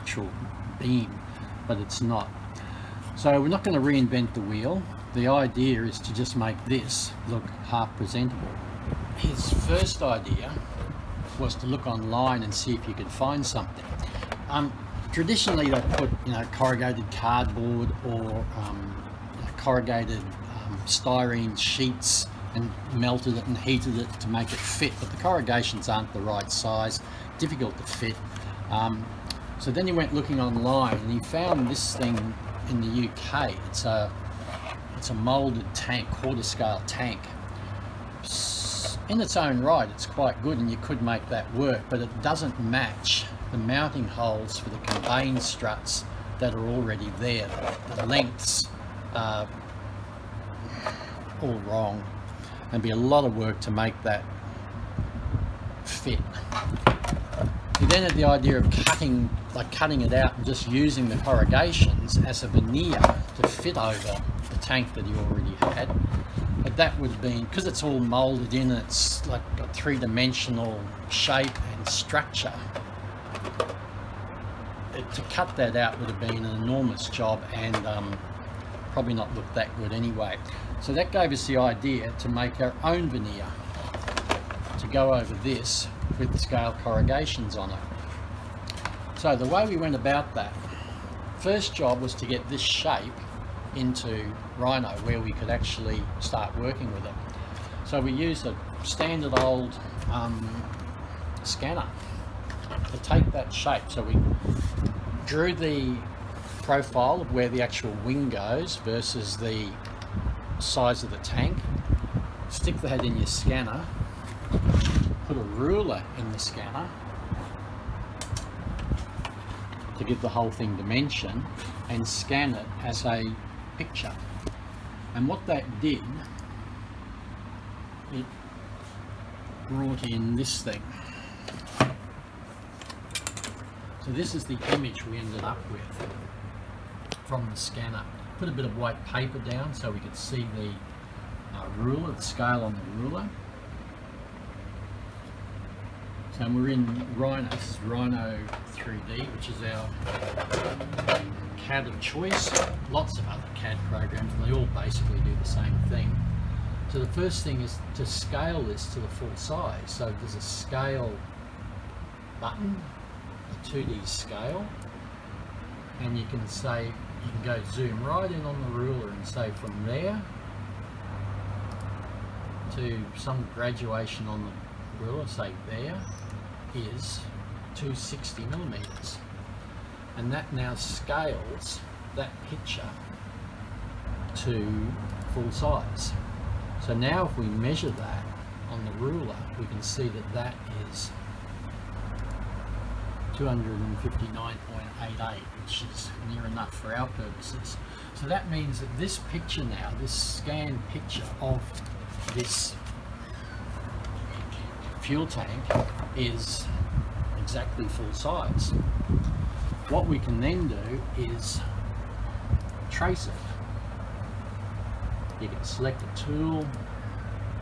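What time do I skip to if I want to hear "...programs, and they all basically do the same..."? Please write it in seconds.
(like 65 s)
153 s.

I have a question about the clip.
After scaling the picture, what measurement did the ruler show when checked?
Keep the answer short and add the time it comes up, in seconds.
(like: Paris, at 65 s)
259.88, at 193 s.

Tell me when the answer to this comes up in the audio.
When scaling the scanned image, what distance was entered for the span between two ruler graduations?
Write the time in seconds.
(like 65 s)
177 s.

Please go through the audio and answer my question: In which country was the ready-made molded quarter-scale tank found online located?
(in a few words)
UK.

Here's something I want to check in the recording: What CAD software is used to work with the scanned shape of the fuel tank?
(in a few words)
Rhino 3D.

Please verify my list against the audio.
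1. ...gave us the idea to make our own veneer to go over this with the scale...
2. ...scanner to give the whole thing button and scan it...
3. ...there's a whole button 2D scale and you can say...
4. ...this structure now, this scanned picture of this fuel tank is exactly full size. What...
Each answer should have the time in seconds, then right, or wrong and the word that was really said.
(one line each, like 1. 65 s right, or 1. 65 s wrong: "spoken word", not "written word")
1. 81 s right
2. 116 s wrong: "dimension", not "button"
3. 160 s wrong: "scale", not "whole"
4. 198 s wrong: "picture", not "structure".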